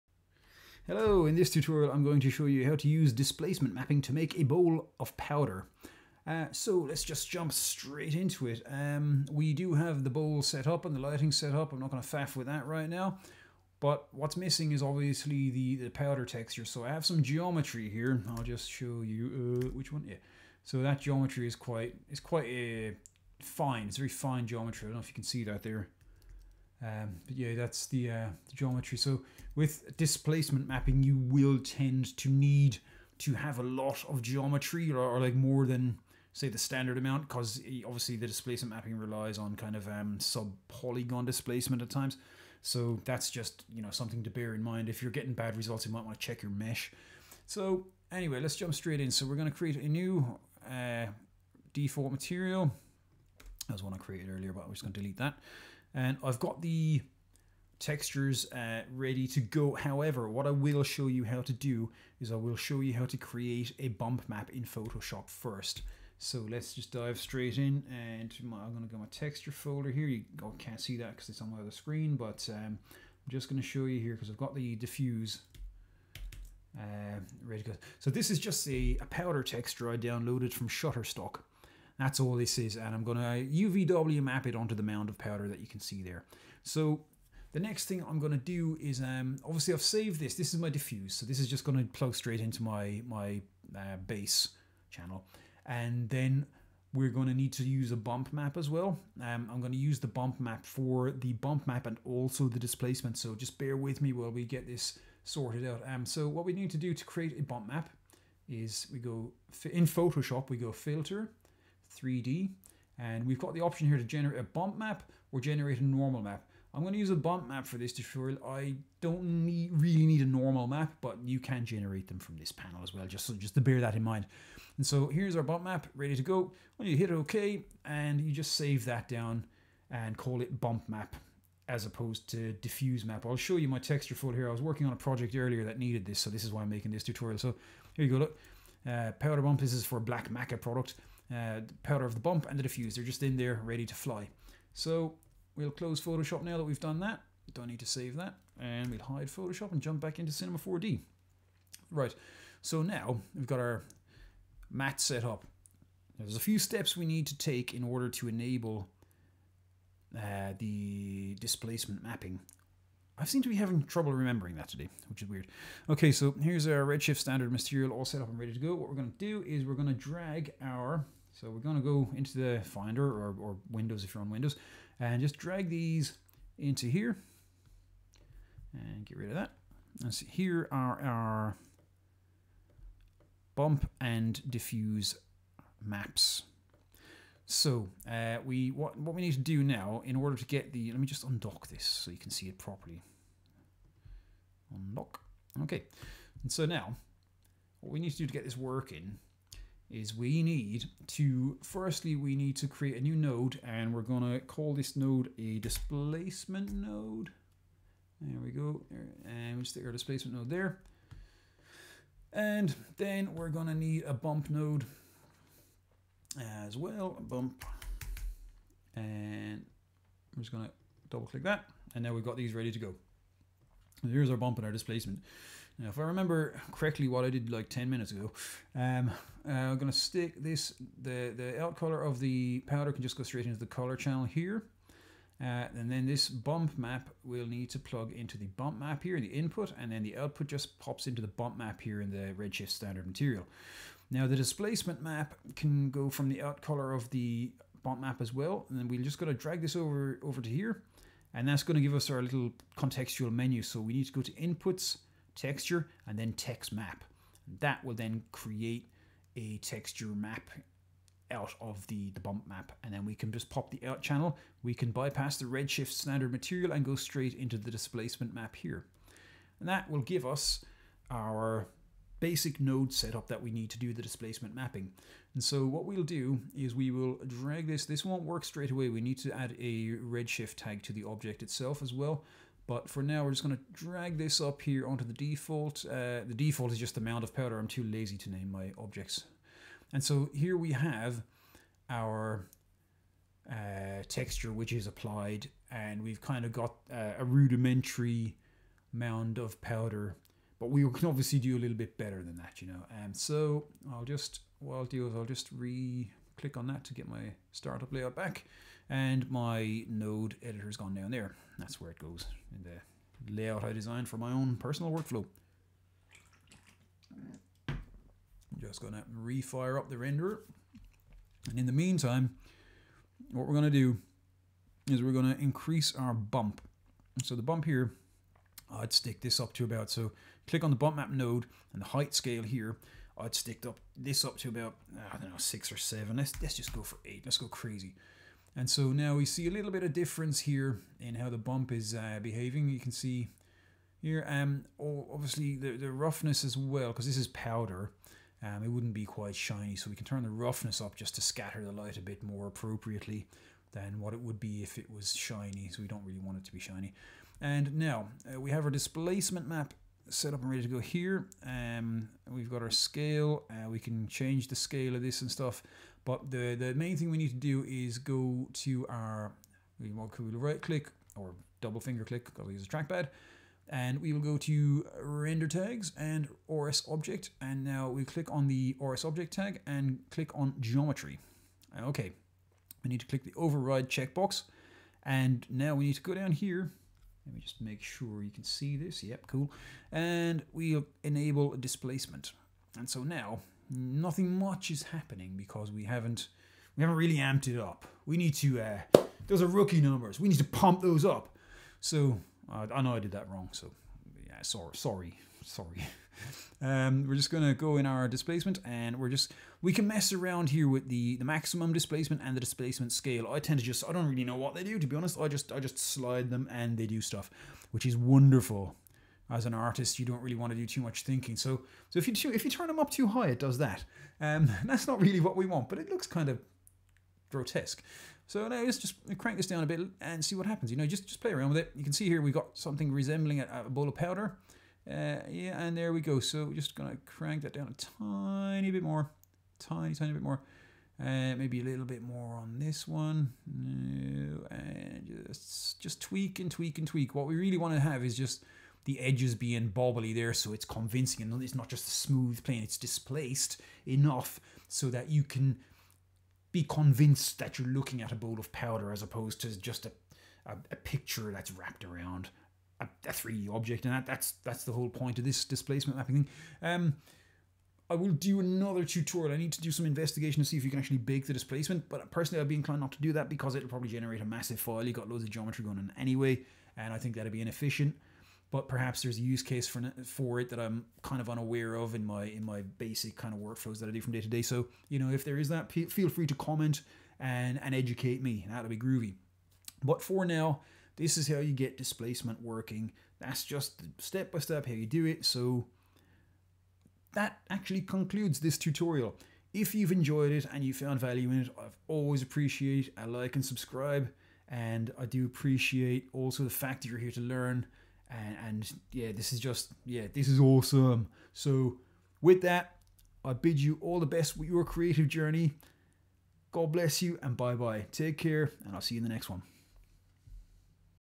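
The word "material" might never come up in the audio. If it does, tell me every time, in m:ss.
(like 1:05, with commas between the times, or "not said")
0:52, 2:47, 4:03, 4:26.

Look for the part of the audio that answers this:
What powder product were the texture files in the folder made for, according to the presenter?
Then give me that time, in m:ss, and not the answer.
2:19.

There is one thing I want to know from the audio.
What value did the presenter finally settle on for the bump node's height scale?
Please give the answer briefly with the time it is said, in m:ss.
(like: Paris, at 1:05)
8, at 5:37.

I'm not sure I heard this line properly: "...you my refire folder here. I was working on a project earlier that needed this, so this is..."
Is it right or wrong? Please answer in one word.
wrong.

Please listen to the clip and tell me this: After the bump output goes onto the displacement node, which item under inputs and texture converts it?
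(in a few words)
text map.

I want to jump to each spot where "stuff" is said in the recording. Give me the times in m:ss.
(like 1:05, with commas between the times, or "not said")
6:05, 6:57.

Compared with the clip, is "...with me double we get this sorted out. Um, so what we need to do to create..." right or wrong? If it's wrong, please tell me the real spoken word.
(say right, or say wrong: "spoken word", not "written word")
wrong: "while", not "double".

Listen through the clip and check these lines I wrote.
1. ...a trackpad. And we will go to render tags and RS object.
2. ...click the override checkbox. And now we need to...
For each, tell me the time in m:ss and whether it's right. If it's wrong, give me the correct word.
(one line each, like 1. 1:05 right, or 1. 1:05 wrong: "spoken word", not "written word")
1. 6:12 right
2. 6:23 right.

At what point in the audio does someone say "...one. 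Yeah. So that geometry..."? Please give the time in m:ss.
0:19.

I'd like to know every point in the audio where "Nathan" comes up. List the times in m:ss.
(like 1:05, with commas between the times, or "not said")
not said.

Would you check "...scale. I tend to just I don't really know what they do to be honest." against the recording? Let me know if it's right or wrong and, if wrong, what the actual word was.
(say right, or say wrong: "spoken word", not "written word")
right.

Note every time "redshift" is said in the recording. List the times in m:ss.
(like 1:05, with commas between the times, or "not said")
2:46, 4:02, 4:25, 4:39.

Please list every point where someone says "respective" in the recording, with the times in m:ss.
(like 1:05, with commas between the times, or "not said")
not said.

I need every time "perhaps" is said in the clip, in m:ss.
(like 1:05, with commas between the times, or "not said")
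7:58.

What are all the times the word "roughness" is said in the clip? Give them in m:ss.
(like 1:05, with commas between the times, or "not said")
5:45, 5:50.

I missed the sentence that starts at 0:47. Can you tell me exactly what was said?
So anyway, let's jump straight in.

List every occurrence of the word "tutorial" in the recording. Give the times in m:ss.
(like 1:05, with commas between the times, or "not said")
0:01, 1:57, 2:17, 7:48, 8:18.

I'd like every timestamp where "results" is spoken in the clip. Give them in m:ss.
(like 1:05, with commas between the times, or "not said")
0:45.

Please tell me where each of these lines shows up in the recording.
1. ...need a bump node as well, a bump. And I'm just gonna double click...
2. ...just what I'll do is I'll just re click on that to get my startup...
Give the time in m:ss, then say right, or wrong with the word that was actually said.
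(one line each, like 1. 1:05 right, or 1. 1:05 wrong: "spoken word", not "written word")
1. 3:33 right
2. 5:04 right.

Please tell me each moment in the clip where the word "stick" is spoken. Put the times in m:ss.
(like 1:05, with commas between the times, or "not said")
3:29, 3:49, 5:28, 5:33.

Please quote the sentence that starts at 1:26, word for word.
So the next thing I'm going to do is, um, obviously I've saved this.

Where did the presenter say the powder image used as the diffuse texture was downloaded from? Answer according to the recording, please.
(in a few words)
Shutterstock.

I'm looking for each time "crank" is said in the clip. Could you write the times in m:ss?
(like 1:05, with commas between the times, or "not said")
7:09, 7:17.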